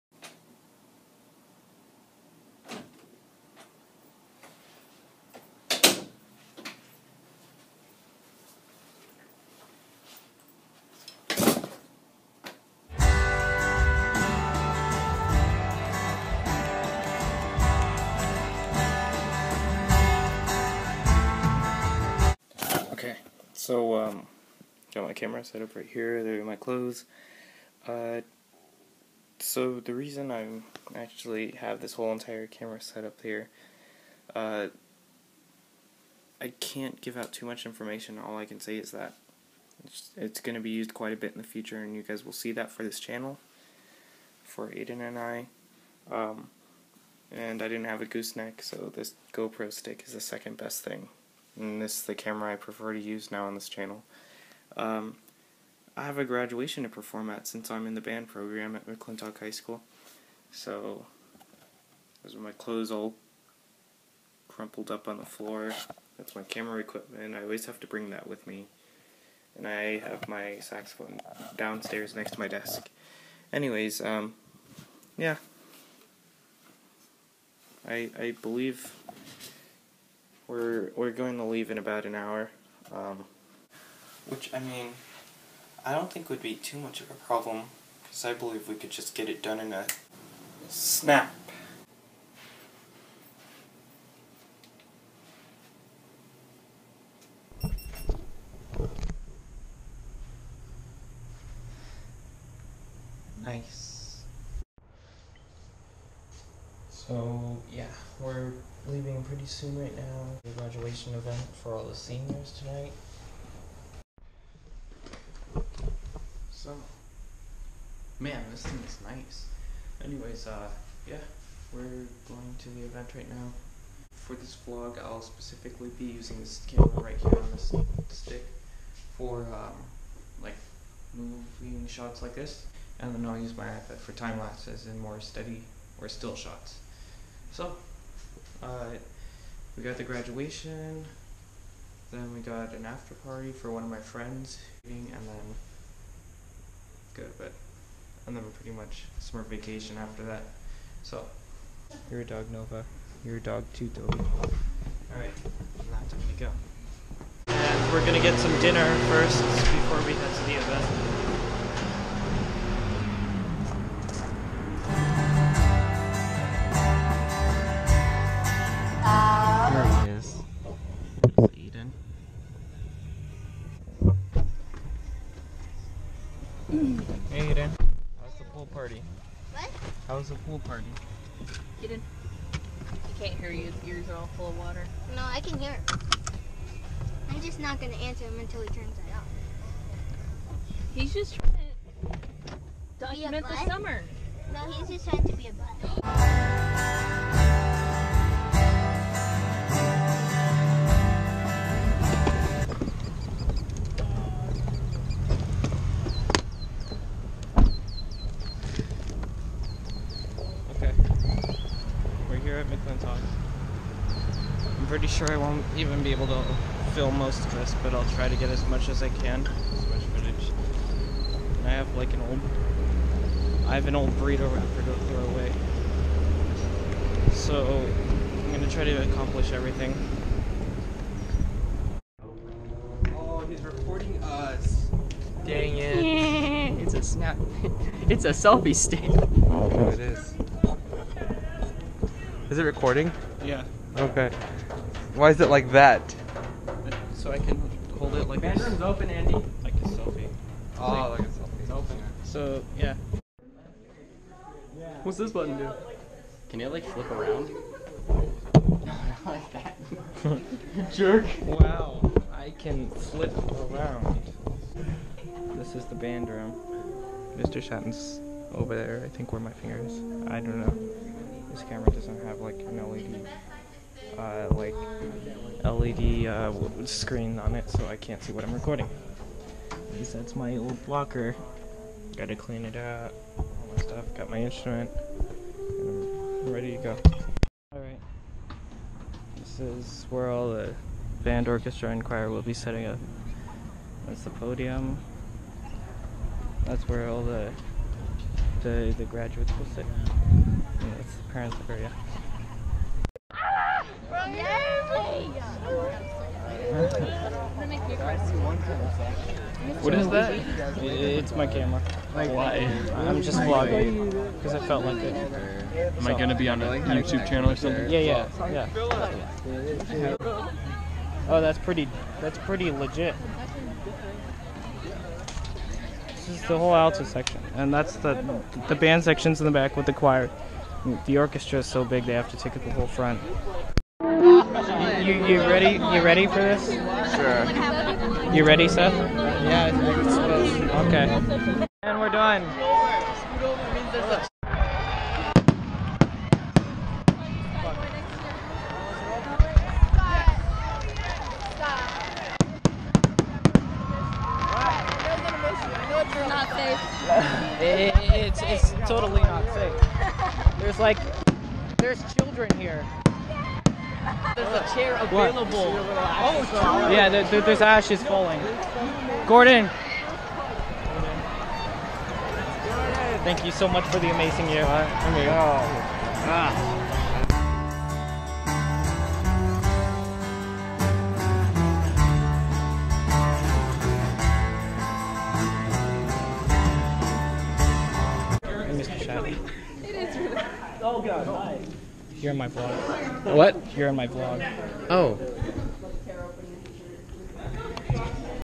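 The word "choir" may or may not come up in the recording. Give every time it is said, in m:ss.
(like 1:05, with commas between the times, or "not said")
4:52, 5:29.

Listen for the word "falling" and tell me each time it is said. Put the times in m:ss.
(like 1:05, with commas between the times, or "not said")
6:08.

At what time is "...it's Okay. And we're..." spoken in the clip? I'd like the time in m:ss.
5:40.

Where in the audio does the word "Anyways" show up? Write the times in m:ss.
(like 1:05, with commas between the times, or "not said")
1:13, 2:00.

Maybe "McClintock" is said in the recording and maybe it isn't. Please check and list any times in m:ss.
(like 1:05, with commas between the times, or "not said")
0:58, 3:32.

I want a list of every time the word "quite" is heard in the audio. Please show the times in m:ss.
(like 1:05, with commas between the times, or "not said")
0:40.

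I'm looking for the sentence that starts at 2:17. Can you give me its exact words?
So, uh, we got the graduation, then we got an after party for one of my friends, and then good.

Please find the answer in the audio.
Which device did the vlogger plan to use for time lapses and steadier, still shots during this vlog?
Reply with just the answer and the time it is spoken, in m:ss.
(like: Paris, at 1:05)
iPad, at 2:13.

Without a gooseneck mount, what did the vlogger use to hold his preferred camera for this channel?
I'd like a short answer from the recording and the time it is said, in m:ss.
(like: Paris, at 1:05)
GoPro stick, at 0:49.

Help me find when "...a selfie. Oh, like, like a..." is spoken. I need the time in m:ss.
4:09.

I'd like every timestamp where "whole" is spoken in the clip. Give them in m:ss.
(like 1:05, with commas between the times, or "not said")
0:31, 5:26, 5:32.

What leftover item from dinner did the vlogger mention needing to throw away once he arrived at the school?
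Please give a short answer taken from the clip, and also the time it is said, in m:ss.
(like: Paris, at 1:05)
An old burrito wrapper, at 3:44.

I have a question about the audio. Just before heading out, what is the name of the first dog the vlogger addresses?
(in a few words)
Nova.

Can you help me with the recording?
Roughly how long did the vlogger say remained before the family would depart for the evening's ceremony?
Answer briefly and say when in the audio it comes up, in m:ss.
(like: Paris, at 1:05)
About an hour, at 1:22.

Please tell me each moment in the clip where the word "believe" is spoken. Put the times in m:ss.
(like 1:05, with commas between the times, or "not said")
1:18, 1:28.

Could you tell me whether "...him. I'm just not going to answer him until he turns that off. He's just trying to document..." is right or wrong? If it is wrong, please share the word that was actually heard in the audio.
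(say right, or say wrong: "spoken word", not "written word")
right.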